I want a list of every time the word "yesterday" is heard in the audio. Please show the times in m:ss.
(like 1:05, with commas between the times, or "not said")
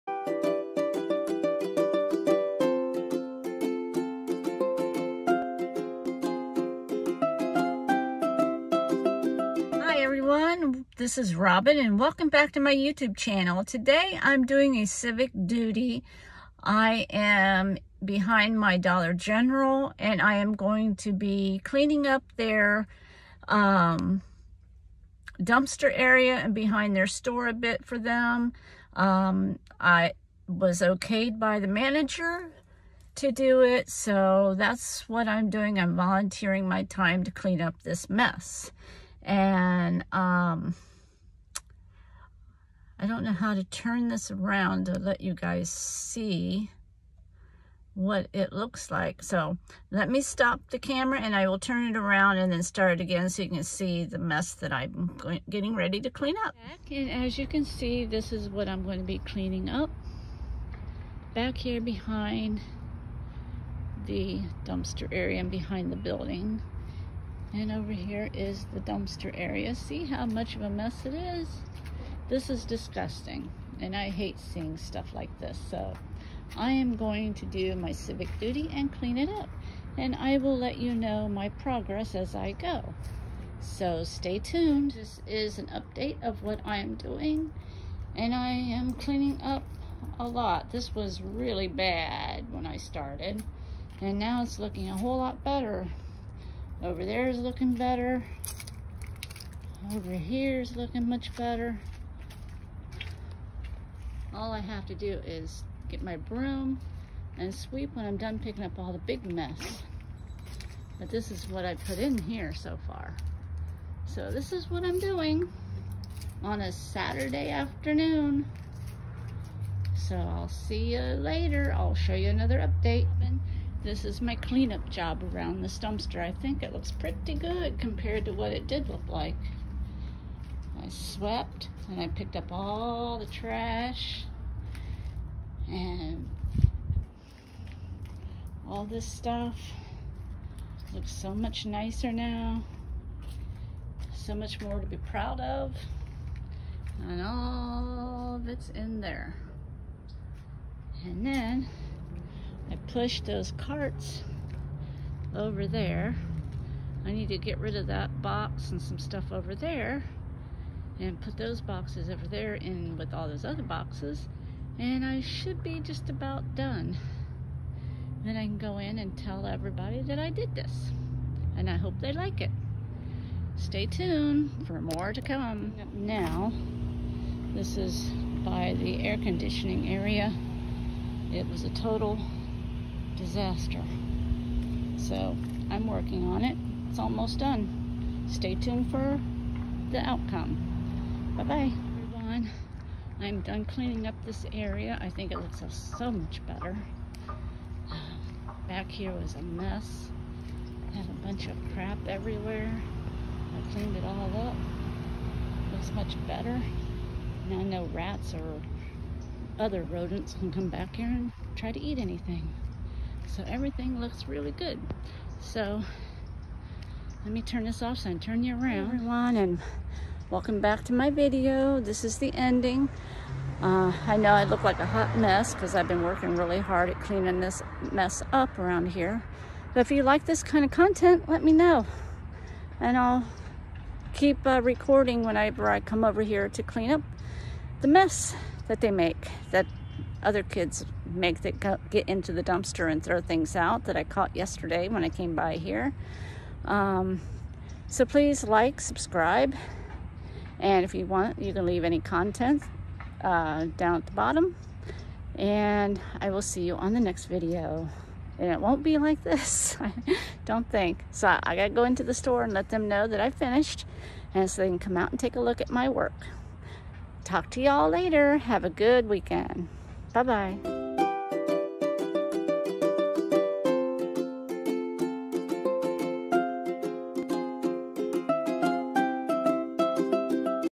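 4:04.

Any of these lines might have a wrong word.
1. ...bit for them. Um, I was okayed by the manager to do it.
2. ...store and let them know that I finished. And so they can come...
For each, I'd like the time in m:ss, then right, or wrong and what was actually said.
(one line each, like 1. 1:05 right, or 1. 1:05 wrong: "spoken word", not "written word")
1. 0:27 right
2. 4:22 right.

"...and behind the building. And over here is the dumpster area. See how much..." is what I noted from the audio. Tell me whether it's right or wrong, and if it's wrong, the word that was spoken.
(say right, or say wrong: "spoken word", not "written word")
right.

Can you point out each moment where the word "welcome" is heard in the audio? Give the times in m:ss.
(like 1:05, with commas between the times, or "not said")
0:11, 3:40.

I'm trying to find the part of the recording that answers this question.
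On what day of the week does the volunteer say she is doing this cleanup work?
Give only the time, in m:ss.
1:56.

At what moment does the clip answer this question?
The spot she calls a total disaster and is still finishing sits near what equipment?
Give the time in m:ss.
2:59.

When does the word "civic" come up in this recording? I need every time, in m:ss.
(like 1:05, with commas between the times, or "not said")
0:14, 1:17.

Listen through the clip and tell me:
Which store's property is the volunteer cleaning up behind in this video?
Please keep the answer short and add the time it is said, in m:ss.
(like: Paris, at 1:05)
Dollar General, at 0:18.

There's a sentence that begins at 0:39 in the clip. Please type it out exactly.
And um, I don't know how to turn this around to let you guys see what it looks like.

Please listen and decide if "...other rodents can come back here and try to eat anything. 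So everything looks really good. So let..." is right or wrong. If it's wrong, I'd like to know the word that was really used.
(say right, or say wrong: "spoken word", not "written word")
right.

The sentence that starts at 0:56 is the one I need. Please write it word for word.
And as you can see, this is what I'm going to be cleaning up.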